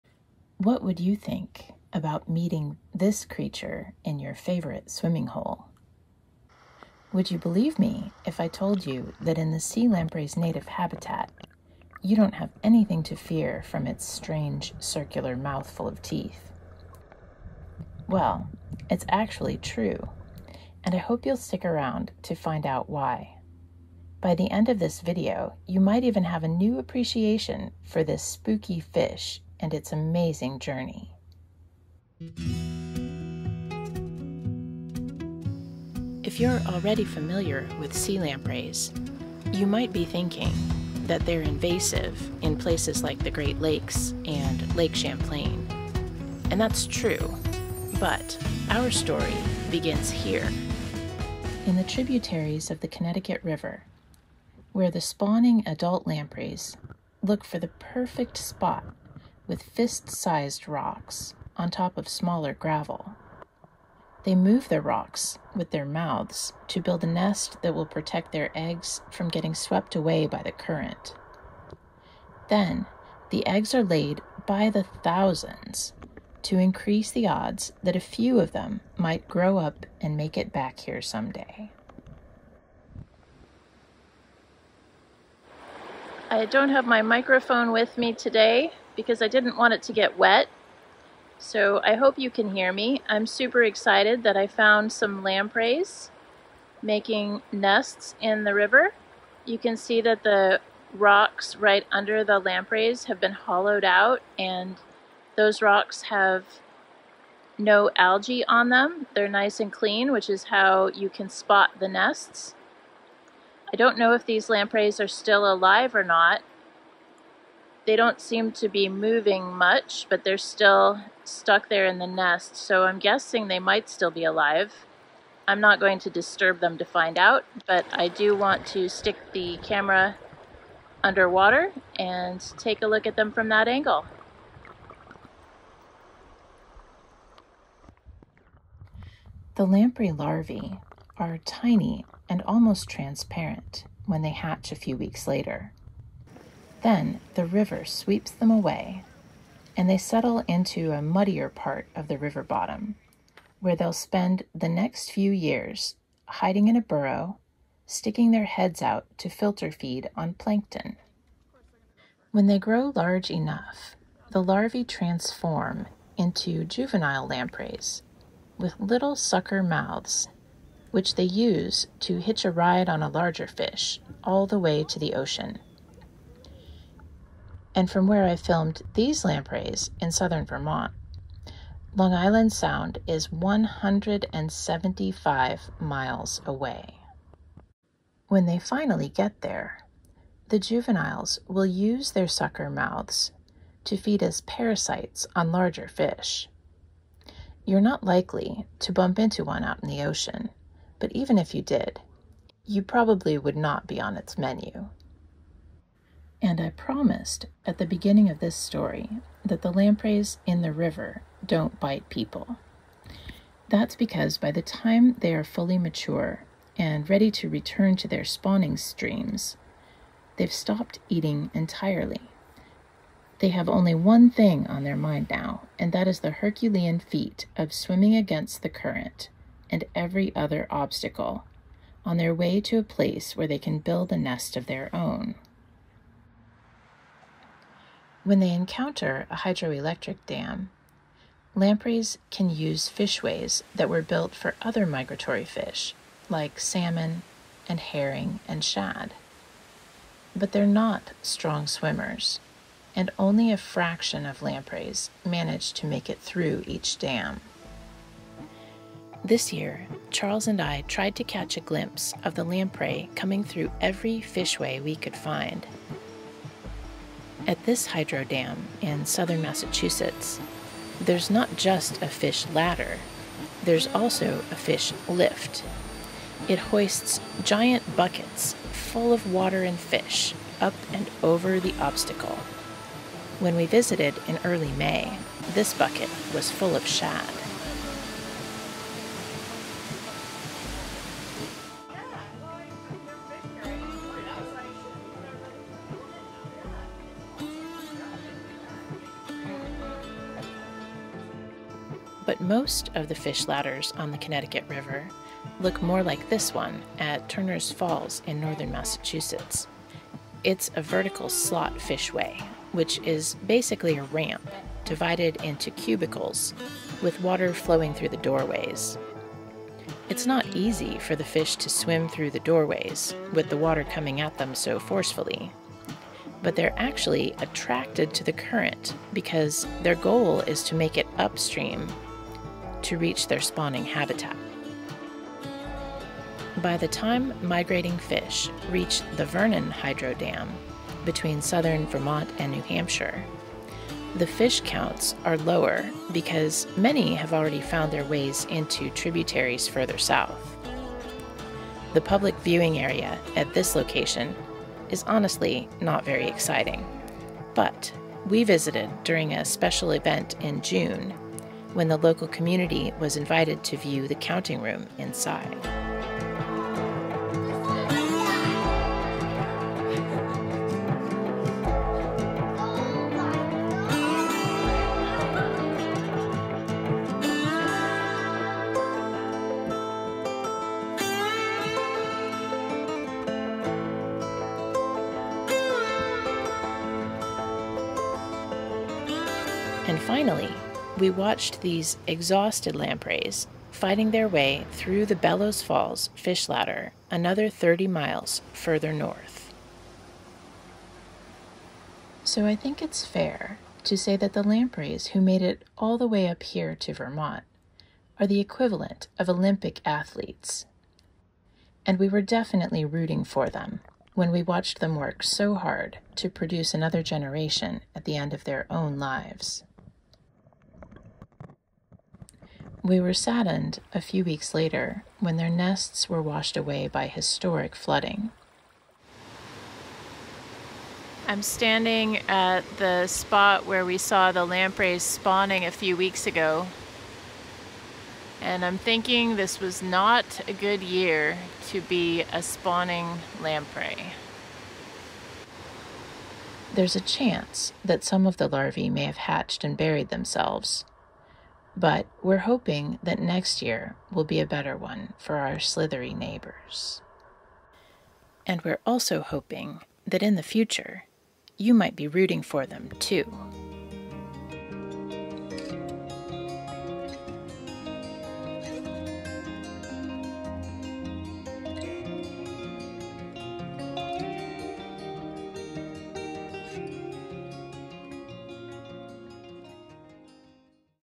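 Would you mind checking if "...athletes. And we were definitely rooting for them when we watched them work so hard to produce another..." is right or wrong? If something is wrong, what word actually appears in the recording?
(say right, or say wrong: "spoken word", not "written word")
right.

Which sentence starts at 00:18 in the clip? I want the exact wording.
Well, it's actually true, and I hope you'll stick around to find out why.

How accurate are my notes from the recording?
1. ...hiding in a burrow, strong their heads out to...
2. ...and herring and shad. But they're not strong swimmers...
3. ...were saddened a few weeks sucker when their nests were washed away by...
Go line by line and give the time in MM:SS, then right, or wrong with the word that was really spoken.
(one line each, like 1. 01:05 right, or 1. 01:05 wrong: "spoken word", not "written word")
1. 02:36 wrong: "sticking", not "strong"
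2. 04:07 right
3. 07:02 wrong: "later", not "sucker".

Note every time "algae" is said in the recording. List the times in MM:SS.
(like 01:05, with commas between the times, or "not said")
01:47.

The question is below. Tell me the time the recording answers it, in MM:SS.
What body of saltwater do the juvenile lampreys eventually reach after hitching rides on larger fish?
03:01.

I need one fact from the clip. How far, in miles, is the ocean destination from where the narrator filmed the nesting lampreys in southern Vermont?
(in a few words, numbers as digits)
175 miles.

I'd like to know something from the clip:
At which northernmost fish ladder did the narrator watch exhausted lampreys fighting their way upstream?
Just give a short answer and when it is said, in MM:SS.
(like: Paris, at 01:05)
Bellows Falls, at 06:35.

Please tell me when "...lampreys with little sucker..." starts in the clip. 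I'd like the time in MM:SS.
02:47.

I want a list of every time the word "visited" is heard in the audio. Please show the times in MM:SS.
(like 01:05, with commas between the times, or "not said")
04:43, 05:58.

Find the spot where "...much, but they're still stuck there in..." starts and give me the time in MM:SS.
01:59.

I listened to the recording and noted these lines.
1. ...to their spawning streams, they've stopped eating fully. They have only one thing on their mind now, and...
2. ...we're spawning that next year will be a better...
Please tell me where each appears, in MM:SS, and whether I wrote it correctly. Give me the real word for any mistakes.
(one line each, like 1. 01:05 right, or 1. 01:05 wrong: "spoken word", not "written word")
1. 03:37 wrong: "entirely", not "fully"
2. 07:32 wrong: "hoping", not "spawning".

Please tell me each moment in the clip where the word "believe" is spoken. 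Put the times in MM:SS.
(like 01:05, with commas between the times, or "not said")
00:07.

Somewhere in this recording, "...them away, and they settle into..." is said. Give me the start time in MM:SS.
02:28.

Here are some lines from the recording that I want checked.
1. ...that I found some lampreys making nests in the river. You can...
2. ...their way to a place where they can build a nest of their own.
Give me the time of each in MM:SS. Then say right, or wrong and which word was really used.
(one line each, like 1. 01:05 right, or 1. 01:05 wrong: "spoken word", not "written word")
1. 01:34 right
2. 03:52 right.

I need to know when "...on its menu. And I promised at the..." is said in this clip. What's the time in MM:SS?
03:24.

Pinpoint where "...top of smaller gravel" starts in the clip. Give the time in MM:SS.
01:01.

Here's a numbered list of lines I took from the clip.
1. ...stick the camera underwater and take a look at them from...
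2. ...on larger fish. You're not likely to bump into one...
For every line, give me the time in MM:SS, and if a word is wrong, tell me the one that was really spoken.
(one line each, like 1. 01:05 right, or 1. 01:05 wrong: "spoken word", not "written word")
1. 02:08 right
2. 03:15 right.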